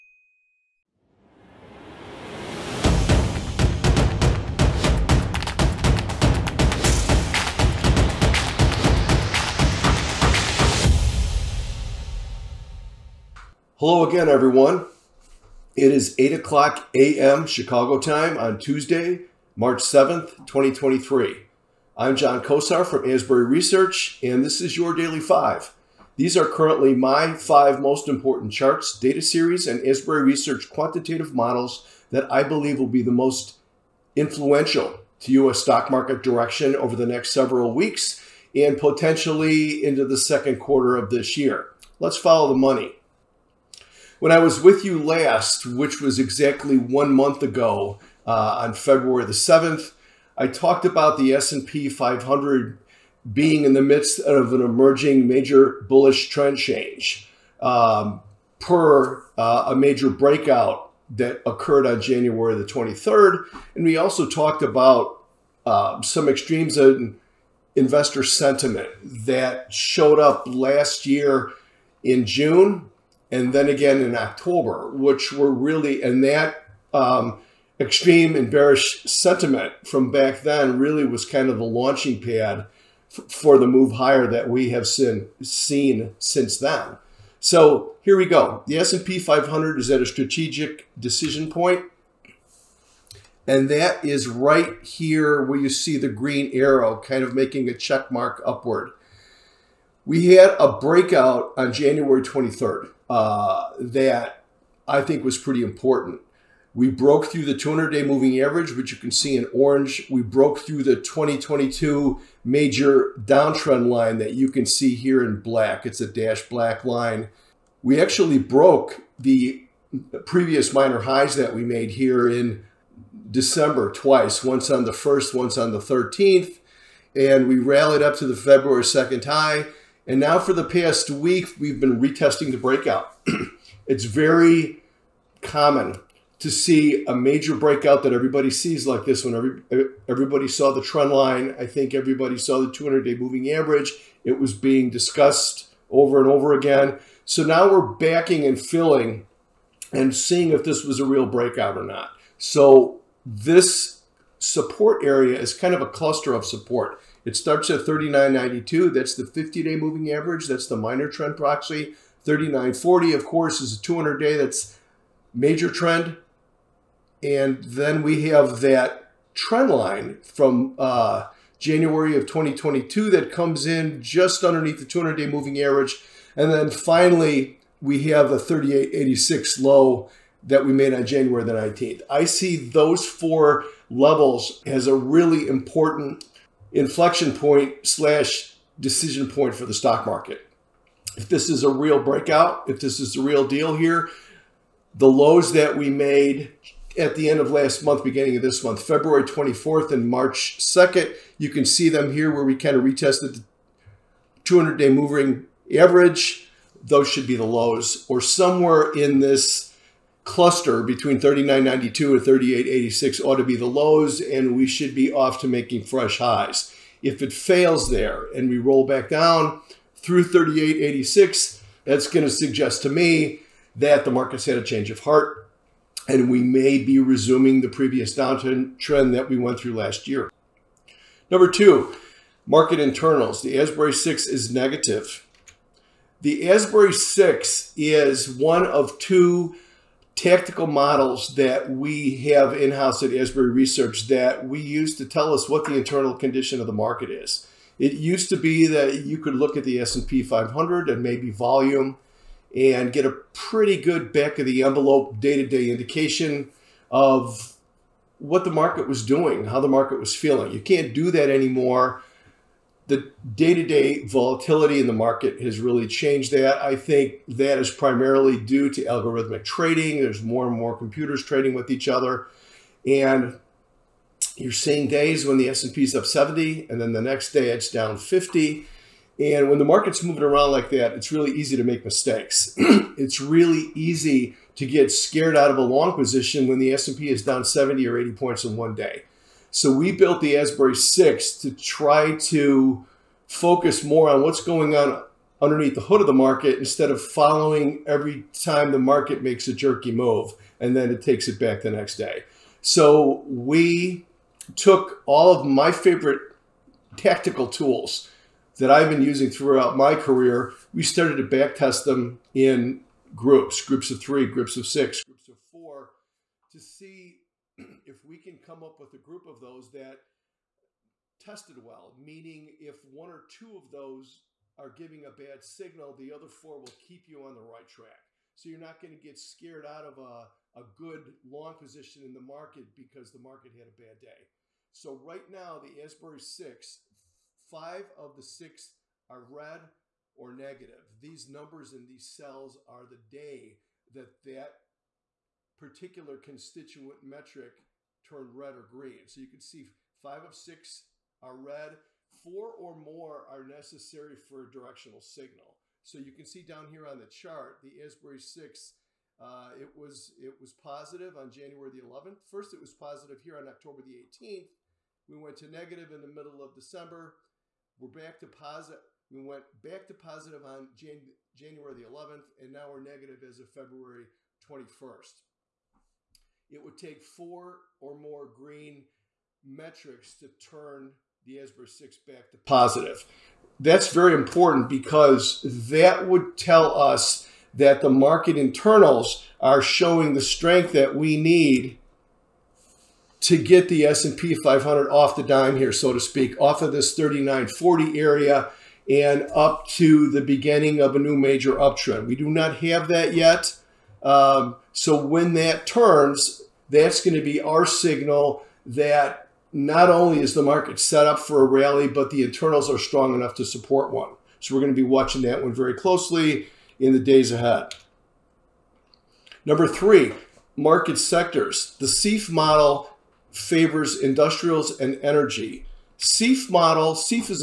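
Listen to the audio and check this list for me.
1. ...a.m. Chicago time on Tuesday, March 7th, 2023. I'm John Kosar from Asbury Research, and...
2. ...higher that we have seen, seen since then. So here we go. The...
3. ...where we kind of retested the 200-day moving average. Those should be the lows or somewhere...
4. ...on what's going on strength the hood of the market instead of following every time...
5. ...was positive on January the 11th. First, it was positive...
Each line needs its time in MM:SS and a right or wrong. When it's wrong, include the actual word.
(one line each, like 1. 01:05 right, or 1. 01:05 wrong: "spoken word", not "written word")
1. 00:16 right
2. 01:23 right
3. 03:22 right
4. 04:54 wrong: "underneath", not "strength"
5. 06:00 right.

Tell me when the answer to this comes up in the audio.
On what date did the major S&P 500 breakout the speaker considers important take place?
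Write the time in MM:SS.
01:41.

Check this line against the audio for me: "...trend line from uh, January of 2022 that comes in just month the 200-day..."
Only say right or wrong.
wrong.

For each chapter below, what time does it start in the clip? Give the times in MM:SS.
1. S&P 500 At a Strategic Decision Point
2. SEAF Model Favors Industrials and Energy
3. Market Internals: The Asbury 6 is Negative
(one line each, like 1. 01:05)
1. 00:43
2. 06:58
3. 03:49.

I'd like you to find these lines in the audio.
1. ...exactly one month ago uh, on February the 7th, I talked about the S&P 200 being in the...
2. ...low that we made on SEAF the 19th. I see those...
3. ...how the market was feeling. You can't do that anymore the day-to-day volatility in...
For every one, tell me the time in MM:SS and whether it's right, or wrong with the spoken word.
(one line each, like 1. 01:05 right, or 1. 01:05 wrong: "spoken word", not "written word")
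1. 00:46 wrong: "500", not "200"
2. 02:59 wrong: "January", not "SEAF"
3. 04:19 right.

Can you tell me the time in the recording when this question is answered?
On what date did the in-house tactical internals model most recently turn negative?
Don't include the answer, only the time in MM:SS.
06:13.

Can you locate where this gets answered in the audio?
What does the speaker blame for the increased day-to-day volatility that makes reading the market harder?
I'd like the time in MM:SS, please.
04:28.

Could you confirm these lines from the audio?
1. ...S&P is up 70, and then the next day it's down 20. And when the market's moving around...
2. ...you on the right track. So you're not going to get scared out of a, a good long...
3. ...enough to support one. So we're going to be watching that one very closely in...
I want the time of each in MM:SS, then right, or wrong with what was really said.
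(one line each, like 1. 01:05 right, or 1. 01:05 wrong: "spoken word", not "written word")
1. 04:35 wrong: "50", not "20"
2. 05:27 right
3. 06:53 right.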